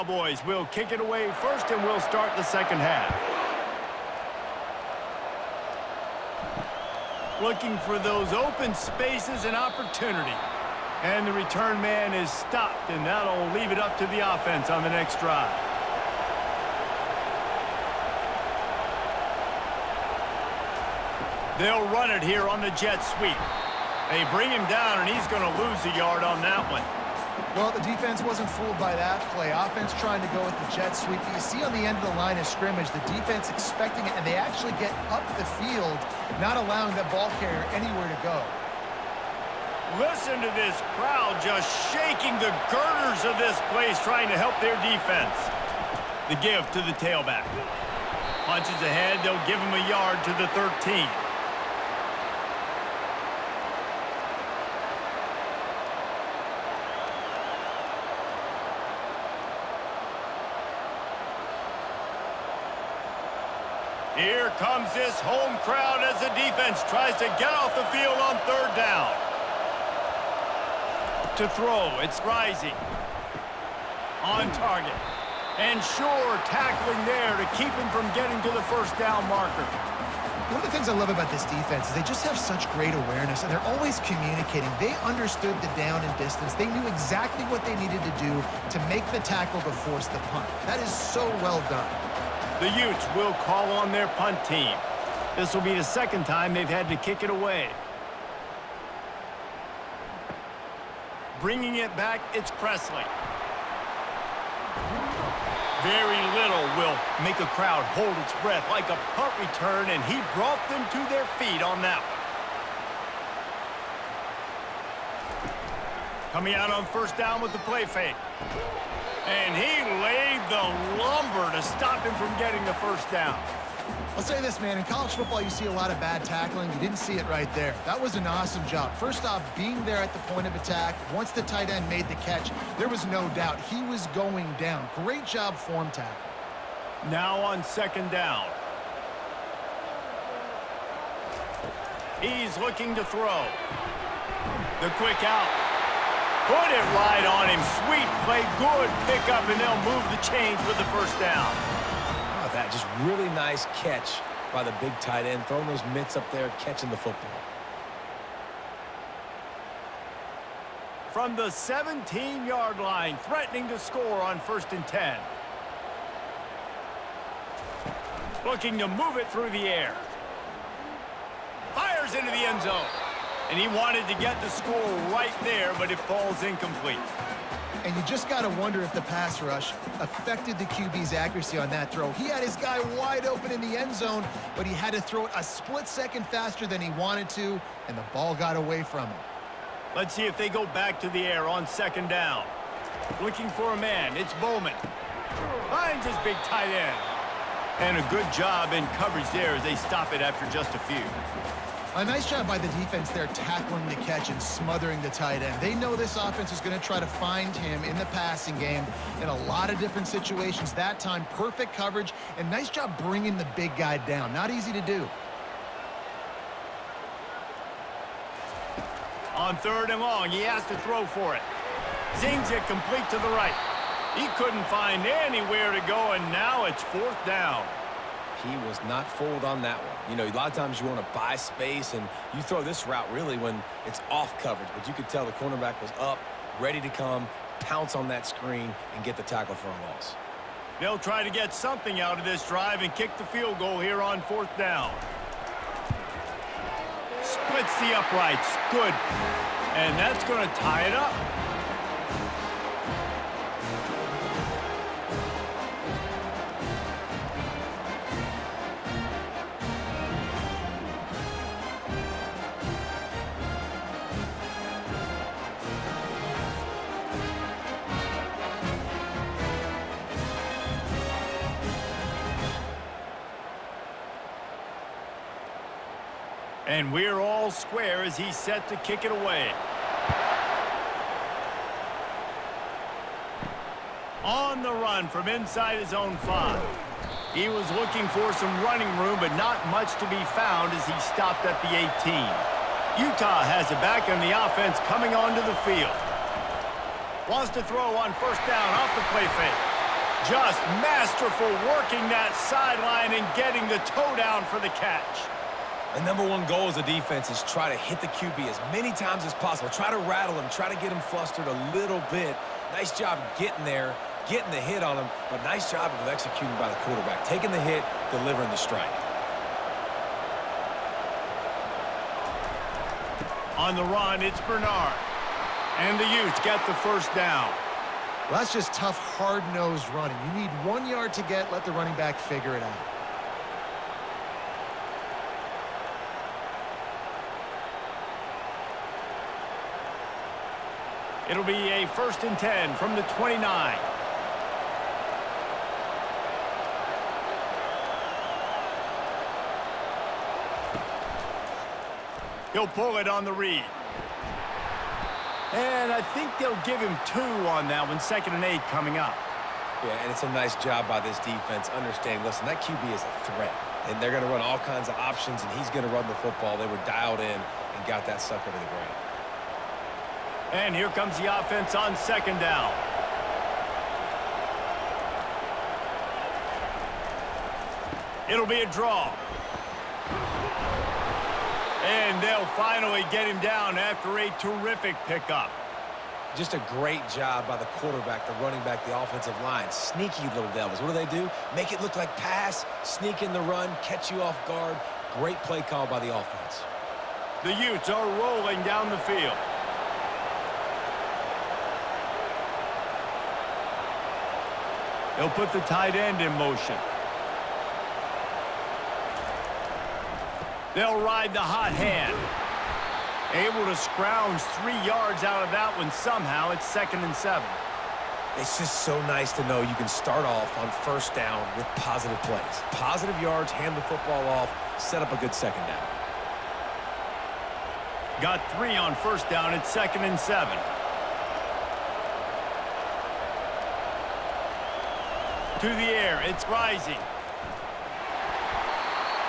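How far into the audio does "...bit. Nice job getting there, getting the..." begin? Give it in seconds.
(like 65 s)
312 s.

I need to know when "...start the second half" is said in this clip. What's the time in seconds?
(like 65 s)
1 s.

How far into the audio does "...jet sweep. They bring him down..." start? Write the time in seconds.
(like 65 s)
22 s.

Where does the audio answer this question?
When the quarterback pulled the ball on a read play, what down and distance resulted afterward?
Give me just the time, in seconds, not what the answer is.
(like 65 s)
357 s.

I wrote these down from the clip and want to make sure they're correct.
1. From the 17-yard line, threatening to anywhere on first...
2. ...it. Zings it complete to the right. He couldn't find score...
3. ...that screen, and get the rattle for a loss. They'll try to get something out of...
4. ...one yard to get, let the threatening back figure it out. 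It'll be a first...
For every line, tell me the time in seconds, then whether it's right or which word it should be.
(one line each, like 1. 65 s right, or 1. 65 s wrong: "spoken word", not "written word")
1. 161 s wrong: "score", not "anywhere"
2. 221 s wrong: "anywhere", not "score"
3. 238 s wrong: "tackle", not "rattle"
4. 330 s wrong: "running", not "threatening".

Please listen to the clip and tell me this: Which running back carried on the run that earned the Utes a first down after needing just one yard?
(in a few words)
Bernard.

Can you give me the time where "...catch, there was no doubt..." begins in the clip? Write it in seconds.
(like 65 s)
132 s.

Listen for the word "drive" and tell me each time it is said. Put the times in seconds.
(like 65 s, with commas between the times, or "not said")
15 s, 242 s.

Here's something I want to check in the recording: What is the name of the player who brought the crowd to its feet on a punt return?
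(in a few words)
Presley.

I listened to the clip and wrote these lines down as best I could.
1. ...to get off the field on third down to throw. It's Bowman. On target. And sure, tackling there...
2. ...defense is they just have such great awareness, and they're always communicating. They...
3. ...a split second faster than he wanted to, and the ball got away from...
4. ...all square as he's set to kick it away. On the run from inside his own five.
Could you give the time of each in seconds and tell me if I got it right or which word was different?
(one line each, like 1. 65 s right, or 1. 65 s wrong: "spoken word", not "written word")
1. 67 s wrong: "Rising", not "Bowman"
2. 81 s right
3. 185 s right
4. 277 s right.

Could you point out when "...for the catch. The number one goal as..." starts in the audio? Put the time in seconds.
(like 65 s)
304 s.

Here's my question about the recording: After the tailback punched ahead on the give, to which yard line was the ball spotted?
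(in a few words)
13.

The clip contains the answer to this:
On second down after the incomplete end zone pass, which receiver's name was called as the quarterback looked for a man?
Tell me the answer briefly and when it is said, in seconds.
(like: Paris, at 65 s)
Bowman, at 194 s.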